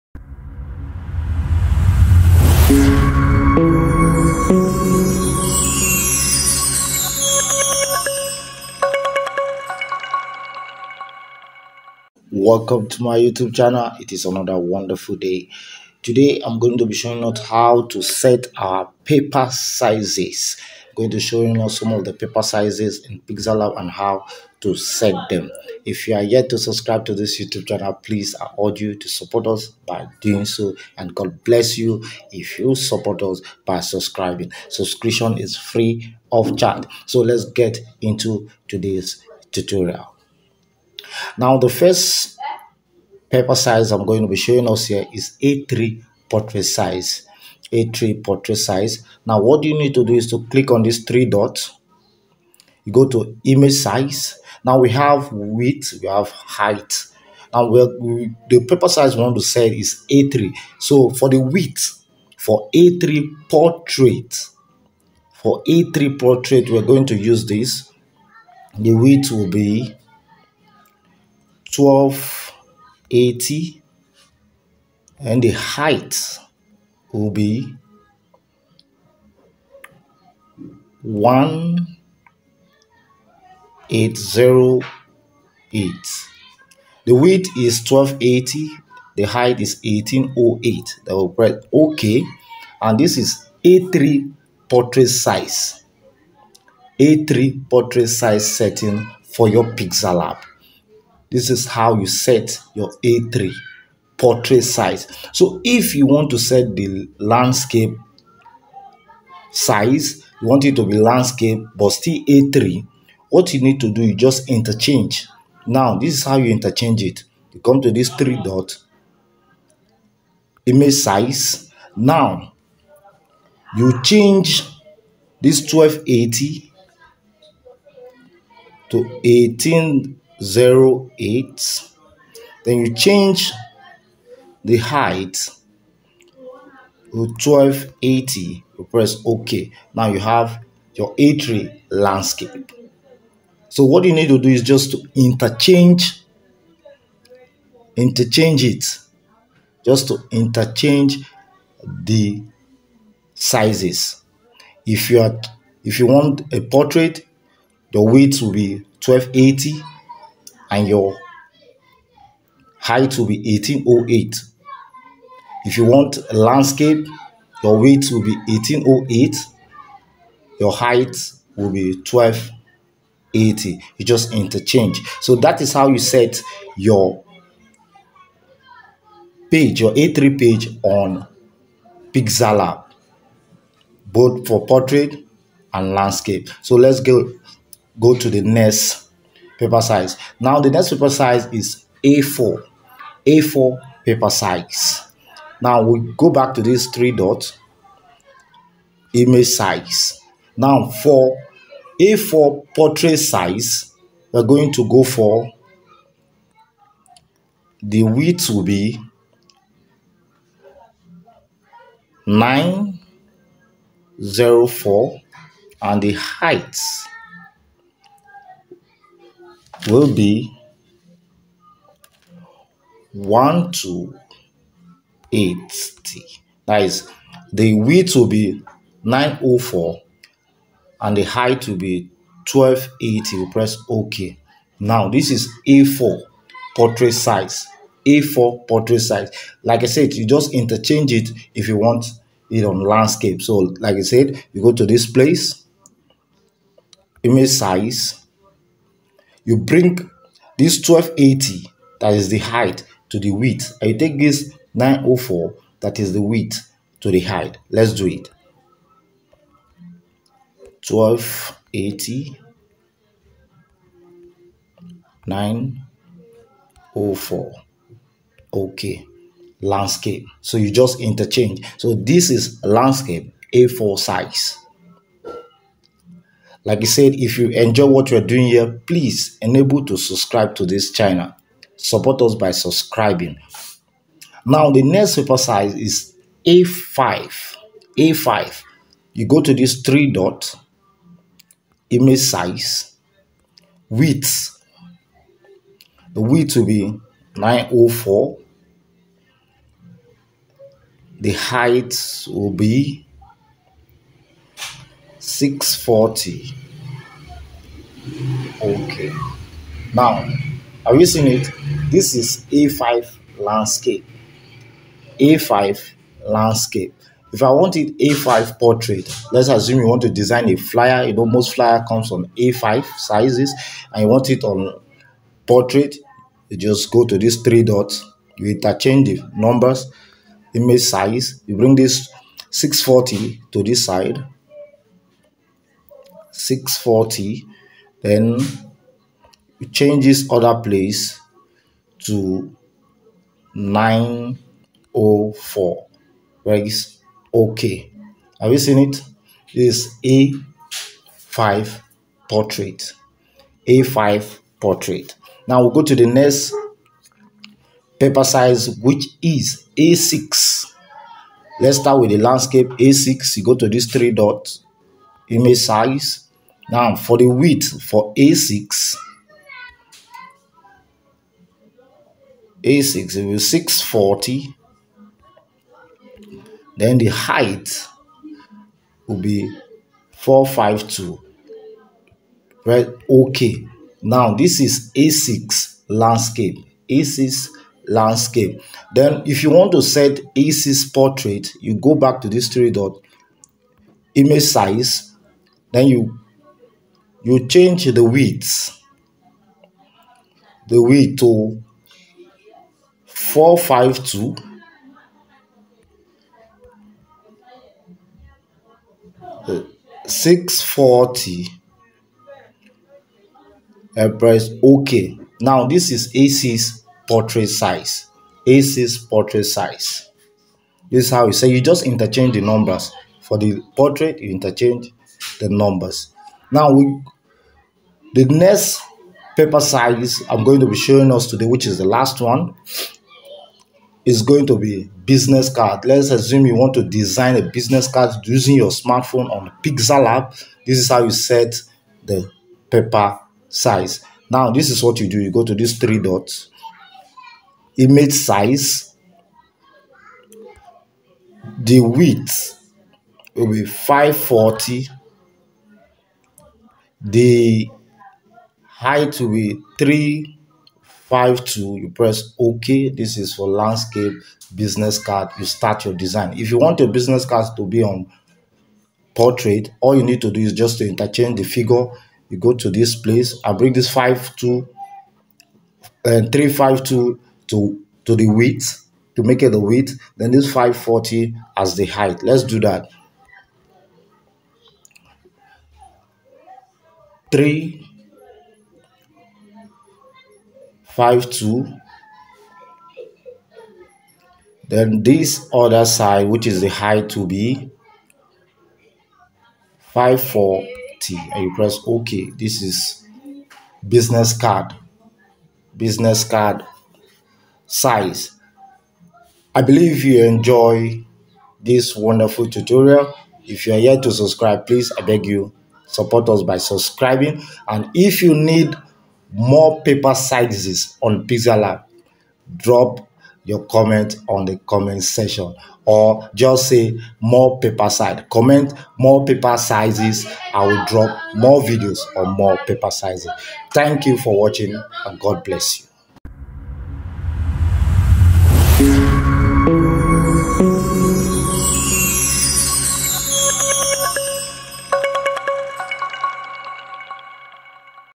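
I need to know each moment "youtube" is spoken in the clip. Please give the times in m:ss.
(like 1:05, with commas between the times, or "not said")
0:13, 0:27.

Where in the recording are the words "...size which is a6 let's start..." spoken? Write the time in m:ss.
5:58.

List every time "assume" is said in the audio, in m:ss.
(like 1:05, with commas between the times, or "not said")
5:19, 7:16.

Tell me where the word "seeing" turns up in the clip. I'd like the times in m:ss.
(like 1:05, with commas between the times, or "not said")
5:11.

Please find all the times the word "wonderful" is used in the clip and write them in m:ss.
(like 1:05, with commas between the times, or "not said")
0:14, 8:31.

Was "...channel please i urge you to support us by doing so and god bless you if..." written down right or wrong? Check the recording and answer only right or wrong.
right.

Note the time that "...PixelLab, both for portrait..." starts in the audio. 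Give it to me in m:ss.
3:02.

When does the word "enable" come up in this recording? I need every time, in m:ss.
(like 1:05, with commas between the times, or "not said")
4:39.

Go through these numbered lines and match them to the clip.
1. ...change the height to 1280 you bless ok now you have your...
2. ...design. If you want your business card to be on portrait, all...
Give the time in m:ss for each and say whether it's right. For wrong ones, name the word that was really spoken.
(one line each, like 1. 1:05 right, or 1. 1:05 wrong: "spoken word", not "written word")
1. 2:12 wrong: "press", not "bless"
2. 7:45 right.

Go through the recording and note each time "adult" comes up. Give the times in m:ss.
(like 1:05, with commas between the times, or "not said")
not said.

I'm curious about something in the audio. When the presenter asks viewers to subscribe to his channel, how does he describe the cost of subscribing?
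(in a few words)
free of charge.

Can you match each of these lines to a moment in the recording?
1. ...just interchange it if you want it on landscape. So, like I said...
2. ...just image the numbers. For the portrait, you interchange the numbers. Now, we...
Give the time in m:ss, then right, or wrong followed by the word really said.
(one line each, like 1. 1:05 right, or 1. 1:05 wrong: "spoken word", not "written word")
1. 4:00 right
2. 7:01 wrong: "interchange", not "image".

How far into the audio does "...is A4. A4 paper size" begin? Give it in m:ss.
3:11.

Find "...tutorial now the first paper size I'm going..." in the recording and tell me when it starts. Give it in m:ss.
0:39.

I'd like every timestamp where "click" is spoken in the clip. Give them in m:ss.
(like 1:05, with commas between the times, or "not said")
0:50.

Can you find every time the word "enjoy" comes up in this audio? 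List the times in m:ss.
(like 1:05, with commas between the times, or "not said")
4:37, 8:30.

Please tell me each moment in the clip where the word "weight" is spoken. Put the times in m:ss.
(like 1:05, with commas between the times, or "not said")
2:47.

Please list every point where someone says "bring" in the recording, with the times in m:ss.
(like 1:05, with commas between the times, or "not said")
4:09, 5:31, 7:53.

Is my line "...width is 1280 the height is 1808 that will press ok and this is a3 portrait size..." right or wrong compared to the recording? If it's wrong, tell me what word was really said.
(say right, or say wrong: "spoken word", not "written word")
right.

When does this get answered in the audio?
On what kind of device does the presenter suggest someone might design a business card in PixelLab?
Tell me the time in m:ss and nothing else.
7:18.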